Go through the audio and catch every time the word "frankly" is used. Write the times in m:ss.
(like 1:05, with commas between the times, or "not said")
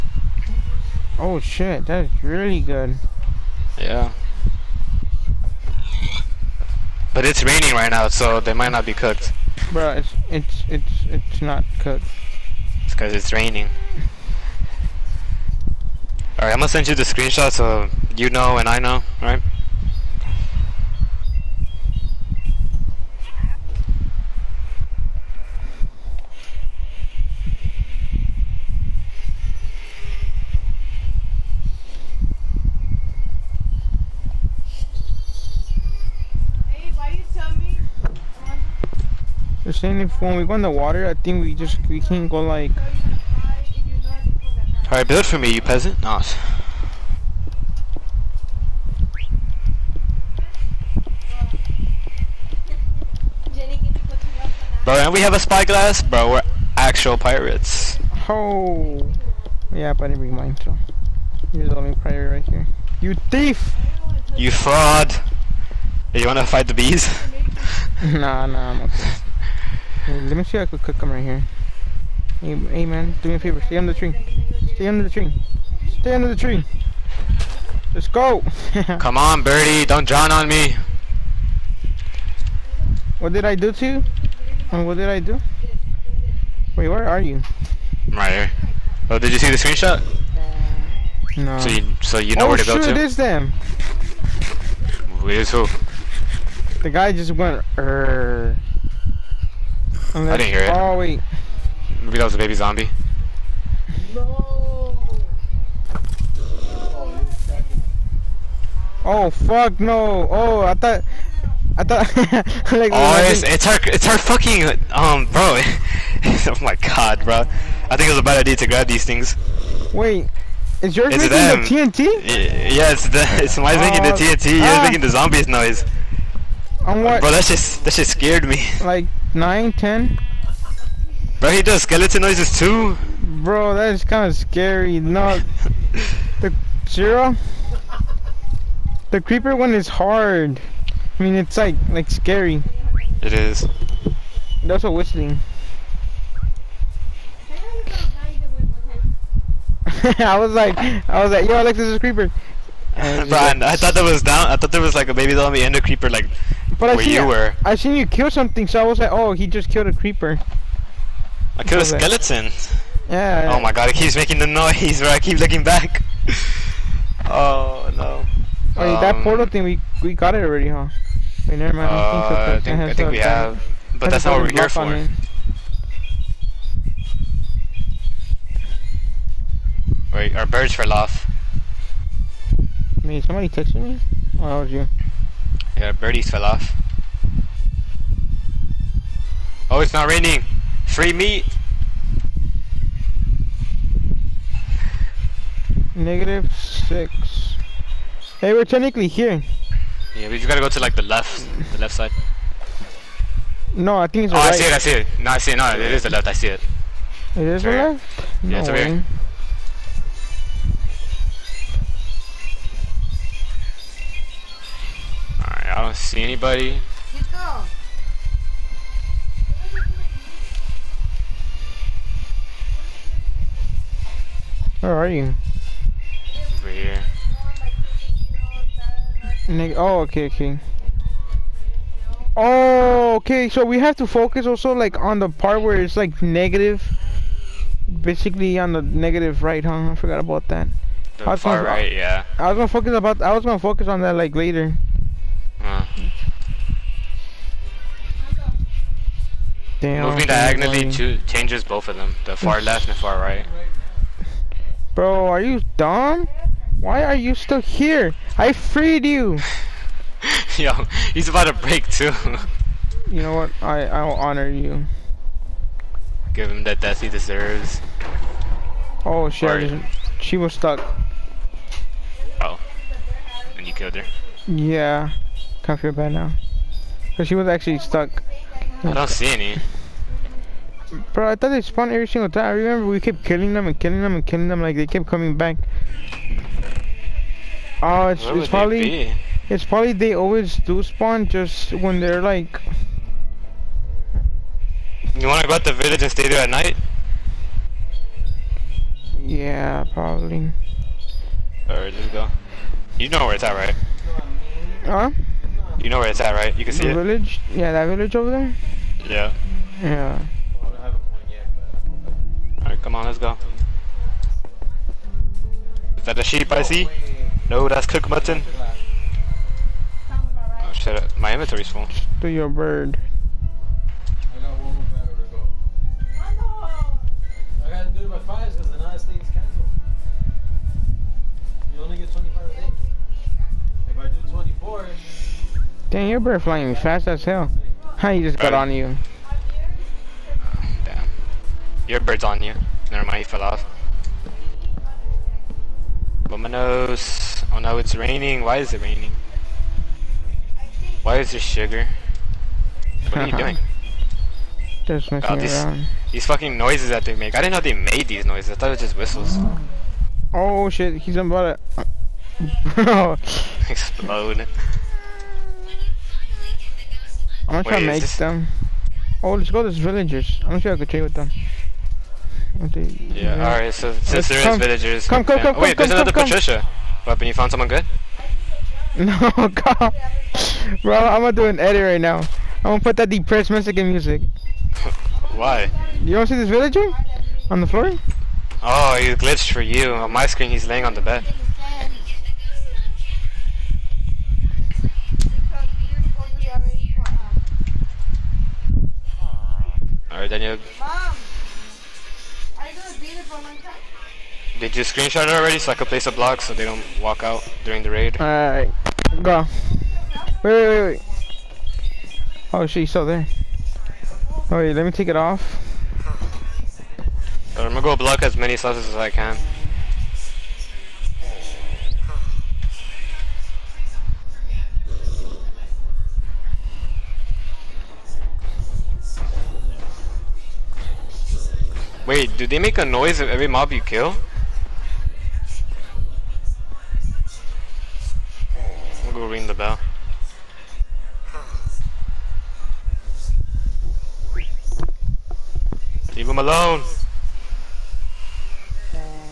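not said.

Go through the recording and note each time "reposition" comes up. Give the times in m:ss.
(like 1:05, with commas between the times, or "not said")
not said.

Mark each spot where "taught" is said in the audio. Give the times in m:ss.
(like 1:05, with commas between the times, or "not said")
not said.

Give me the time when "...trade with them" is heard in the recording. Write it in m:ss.
6:10.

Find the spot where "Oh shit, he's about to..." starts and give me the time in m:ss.
6:00.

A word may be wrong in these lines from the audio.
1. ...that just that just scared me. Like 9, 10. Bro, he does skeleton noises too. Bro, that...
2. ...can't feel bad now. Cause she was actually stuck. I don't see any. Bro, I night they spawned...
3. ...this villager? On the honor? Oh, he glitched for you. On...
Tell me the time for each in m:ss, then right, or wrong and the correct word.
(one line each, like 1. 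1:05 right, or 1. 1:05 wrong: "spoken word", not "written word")
1. 2:07 right
2. 4:35 wrong: "thought", not "night"
3. 6:26 wrong: "floor", not "honor".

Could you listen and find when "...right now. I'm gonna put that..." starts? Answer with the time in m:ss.
6:21.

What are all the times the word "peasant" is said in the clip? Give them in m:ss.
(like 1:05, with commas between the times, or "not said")
0:45.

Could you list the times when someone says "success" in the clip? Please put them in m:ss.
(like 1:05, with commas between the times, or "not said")
not said.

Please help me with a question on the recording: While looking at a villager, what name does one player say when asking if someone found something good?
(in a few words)
Patricia.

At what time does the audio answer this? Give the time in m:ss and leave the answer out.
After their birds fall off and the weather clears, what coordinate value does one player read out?
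3:15.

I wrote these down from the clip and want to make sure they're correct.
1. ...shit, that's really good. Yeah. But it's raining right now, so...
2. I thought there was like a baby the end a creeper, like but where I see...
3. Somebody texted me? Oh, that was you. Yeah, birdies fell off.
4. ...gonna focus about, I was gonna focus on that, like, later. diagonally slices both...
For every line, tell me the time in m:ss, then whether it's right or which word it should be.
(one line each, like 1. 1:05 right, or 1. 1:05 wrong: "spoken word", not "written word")
1. 0:01 right
2. 2:34 right
3. 3:03 right
4. 4:02 wrong: "changes", not "slices".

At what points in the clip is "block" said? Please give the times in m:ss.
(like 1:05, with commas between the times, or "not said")
6:46, 6:57.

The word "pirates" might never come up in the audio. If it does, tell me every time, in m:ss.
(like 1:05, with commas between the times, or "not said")
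0:57, 1:01.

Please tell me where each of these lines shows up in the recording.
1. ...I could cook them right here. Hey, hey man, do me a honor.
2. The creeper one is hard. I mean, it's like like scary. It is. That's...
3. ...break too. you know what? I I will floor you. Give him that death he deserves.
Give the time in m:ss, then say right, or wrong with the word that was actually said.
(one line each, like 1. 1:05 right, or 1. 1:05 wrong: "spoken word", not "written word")
1. 1:10 wrong: "favor", not "honor"
2. 2:19 right
3. 4:21 wrong: "honor", not "floor".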